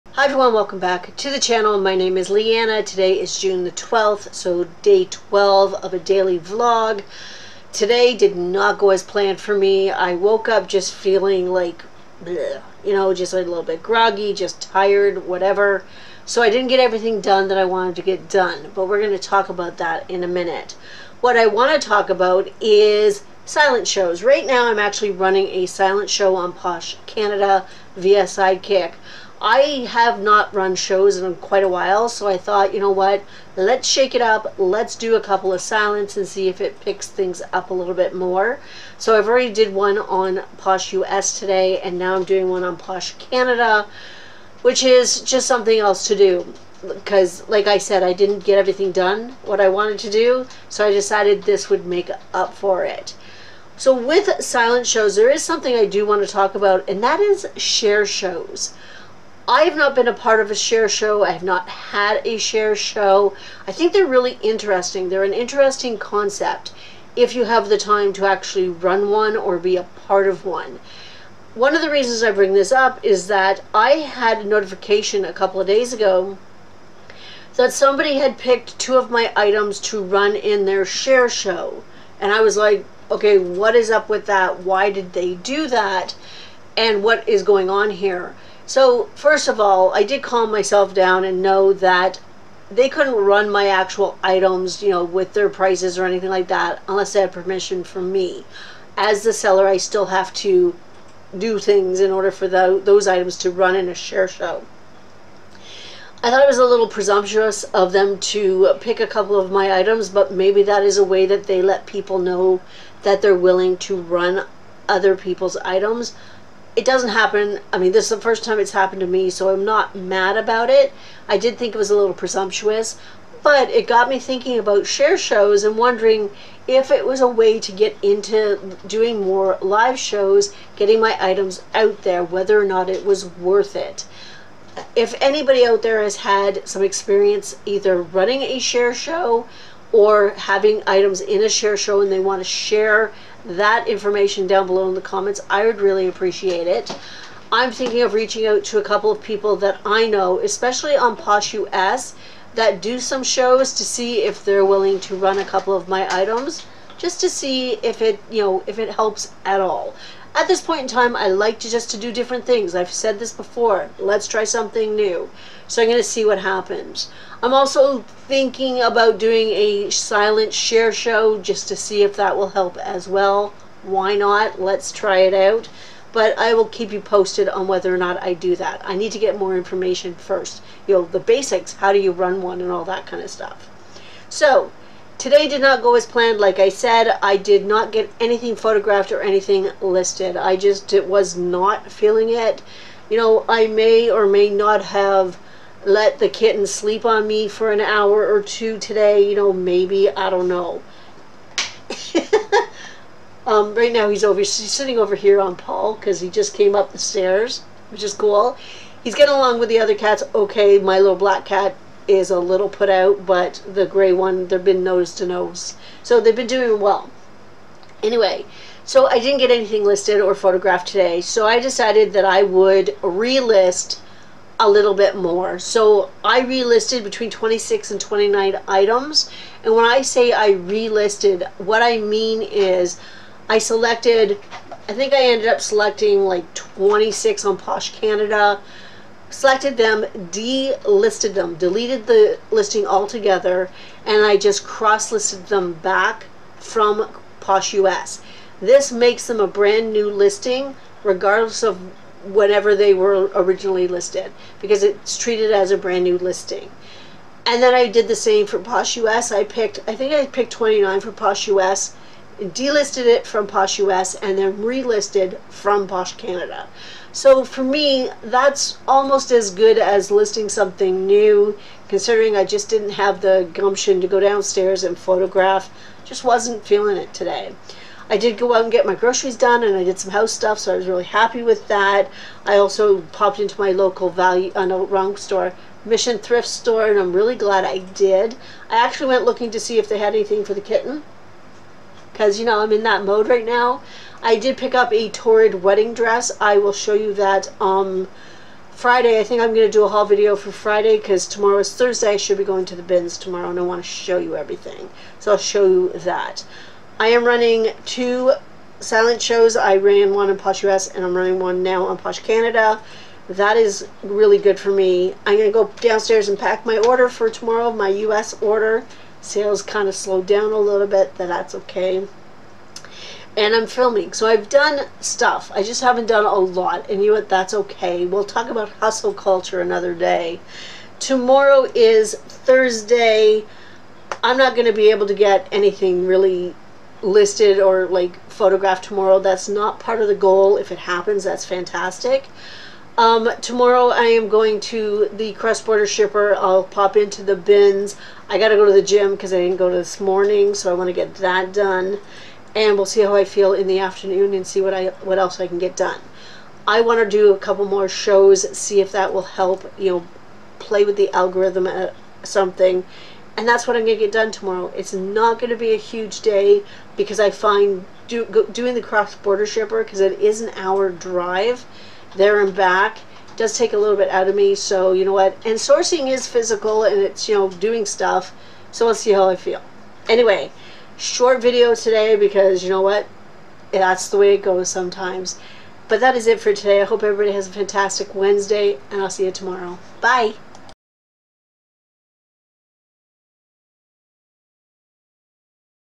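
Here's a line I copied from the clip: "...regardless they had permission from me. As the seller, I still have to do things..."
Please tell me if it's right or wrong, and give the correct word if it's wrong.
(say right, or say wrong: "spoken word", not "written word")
wrong: "unless", not "regardless".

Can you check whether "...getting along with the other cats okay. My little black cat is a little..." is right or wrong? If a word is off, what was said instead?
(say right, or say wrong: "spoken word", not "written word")
right.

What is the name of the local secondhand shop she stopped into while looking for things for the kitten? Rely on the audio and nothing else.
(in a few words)
Mission Thrift Store.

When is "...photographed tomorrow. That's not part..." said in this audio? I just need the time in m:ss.
5:38.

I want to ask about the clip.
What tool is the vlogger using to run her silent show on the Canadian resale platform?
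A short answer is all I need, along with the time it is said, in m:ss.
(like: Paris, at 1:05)
Sidekick, at 0:28.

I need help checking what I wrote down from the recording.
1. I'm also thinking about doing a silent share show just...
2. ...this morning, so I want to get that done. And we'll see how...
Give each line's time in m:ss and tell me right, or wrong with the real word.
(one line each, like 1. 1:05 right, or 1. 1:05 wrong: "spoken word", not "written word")
1. 2:47 right
2. 5:49 right.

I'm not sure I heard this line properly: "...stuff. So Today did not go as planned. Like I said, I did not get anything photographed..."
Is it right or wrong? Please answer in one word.
right.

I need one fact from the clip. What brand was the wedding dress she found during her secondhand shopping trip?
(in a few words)
Torrid.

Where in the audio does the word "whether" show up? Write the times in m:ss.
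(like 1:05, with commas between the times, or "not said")
2:12, 2:57.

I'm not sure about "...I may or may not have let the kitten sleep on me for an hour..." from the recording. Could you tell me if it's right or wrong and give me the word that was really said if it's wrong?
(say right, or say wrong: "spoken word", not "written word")
right.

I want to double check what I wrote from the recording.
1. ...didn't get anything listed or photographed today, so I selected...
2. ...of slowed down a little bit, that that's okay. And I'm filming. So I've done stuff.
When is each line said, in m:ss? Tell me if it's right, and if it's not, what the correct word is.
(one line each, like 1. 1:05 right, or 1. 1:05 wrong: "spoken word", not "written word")
1. 3:39 wrong: "decided", not "selected"
2. 5:19 right.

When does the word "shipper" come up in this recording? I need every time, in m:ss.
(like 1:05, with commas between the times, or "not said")
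5:45, 6:09.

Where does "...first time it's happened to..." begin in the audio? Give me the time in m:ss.
1:58.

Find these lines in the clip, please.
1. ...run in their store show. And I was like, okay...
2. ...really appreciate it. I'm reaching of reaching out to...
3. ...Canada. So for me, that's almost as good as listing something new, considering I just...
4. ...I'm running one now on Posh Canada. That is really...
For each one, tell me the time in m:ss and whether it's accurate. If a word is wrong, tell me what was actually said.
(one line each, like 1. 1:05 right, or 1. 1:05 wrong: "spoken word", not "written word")
1. 1:20 wrong: "share", not "store"
2. 2:25 wrong: "thinking", not "reaching"
3. 4:26 right
4. 5:11 right.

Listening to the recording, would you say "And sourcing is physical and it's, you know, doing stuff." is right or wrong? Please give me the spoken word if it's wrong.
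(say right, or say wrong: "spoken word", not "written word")
right.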